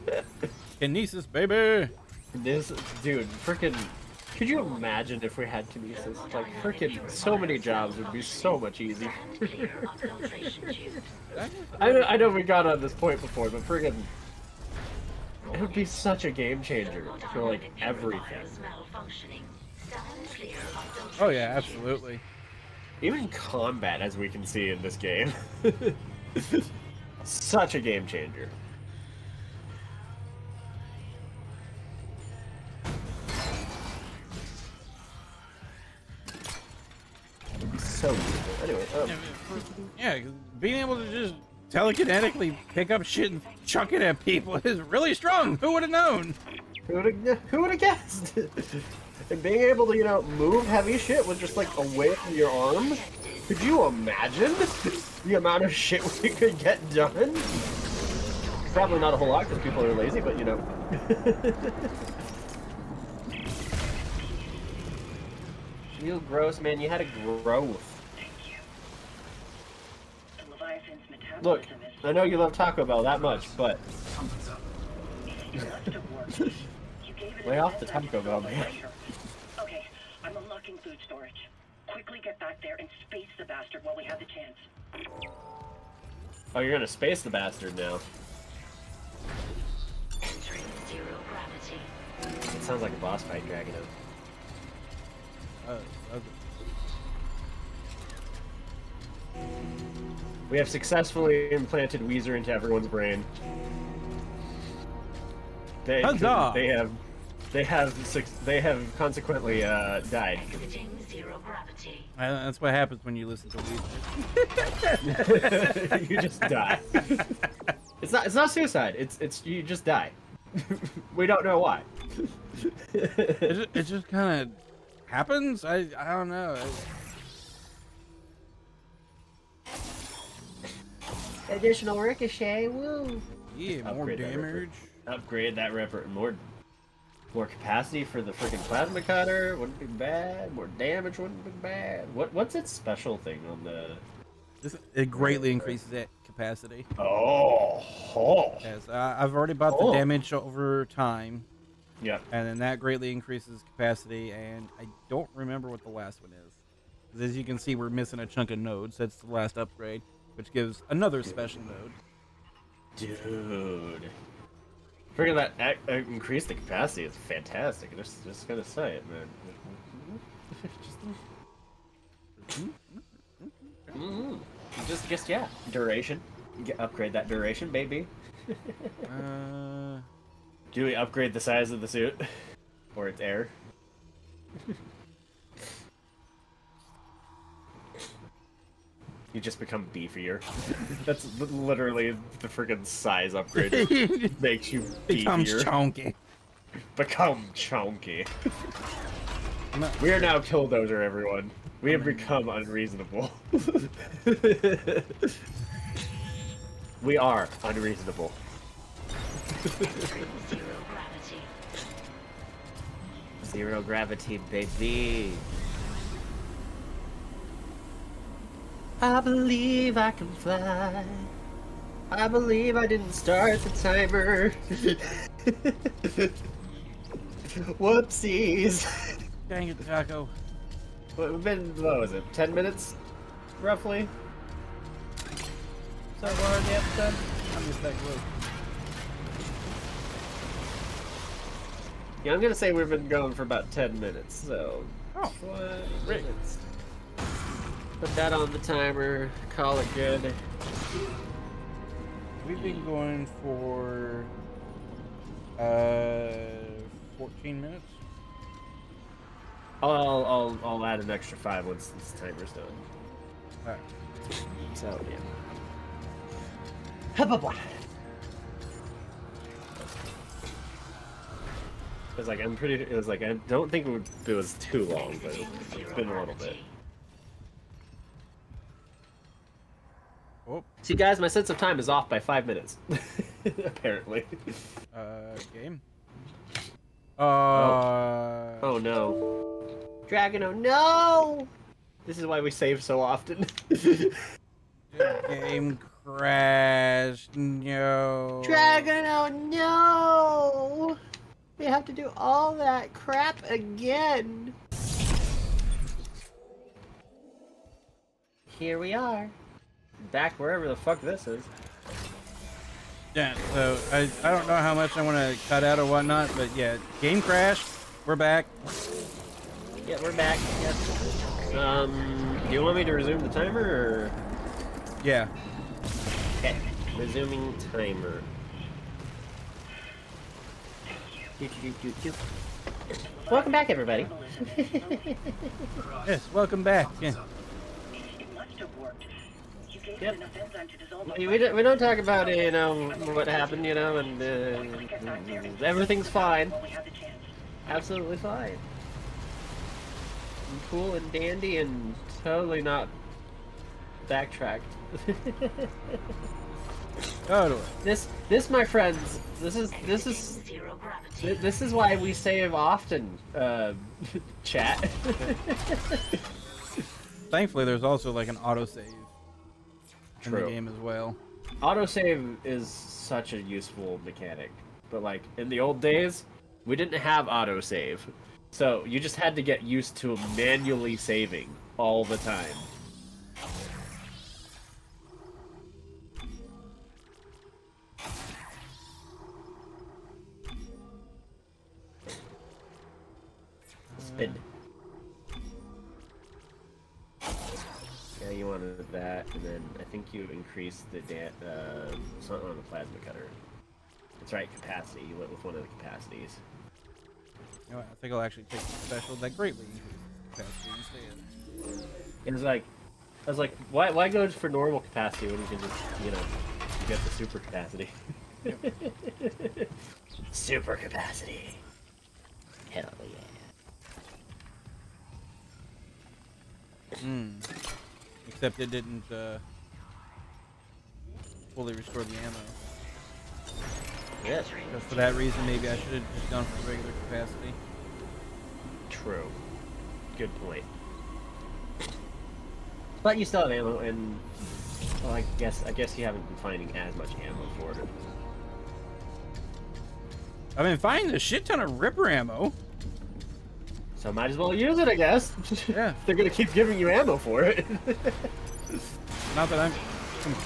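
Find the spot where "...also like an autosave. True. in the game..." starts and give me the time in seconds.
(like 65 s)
367 s.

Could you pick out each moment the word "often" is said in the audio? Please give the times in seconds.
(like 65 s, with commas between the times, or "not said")
293 s, 362 s.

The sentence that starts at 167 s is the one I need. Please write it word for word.
Just, just gonna say it, man.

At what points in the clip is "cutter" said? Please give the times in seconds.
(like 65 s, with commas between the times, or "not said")
139 s, 403 s.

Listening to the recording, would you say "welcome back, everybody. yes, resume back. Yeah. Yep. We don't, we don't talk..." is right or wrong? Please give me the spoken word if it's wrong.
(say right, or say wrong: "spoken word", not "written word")
wrong: "welcome", not "resume".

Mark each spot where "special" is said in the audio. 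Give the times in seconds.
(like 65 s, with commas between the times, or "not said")
142 s, 161 s, 408 s.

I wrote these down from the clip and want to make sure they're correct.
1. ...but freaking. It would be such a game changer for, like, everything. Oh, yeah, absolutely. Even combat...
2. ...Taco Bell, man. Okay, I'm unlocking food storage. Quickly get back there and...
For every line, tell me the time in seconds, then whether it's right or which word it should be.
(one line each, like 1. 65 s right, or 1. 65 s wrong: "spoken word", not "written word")
1. 13 s right
2. 77 s right.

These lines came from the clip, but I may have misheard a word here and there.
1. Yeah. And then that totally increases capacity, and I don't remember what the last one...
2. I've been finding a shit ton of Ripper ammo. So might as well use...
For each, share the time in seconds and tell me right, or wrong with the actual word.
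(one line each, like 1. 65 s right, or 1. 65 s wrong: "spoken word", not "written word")
1. 152 s wrong: "greatly", not "totally"
2. 450 s right.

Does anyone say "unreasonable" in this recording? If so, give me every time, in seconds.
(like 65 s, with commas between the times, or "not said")
202 s, 207 s.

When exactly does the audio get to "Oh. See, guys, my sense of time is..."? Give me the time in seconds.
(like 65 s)
280 s.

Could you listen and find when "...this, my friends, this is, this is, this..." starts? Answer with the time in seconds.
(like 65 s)
358 s.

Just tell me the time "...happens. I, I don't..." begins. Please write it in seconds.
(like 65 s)
125 s.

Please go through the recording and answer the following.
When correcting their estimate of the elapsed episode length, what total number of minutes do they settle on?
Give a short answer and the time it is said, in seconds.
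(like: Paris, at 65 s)
14, at 257 s.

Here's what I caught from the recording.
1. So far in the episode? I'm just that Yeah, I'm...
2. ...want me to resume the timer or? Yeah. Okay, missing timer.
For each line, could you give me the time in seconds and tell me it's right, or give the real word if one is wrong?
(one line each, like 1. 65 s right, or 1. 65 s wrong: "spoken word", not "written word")
1. 236 s right
2. 322 s wrong: "resuming", not "missing".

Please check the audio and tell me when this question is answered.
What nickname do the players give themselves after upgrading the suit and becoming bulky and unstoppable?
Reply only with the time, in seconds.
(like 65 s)
200 s.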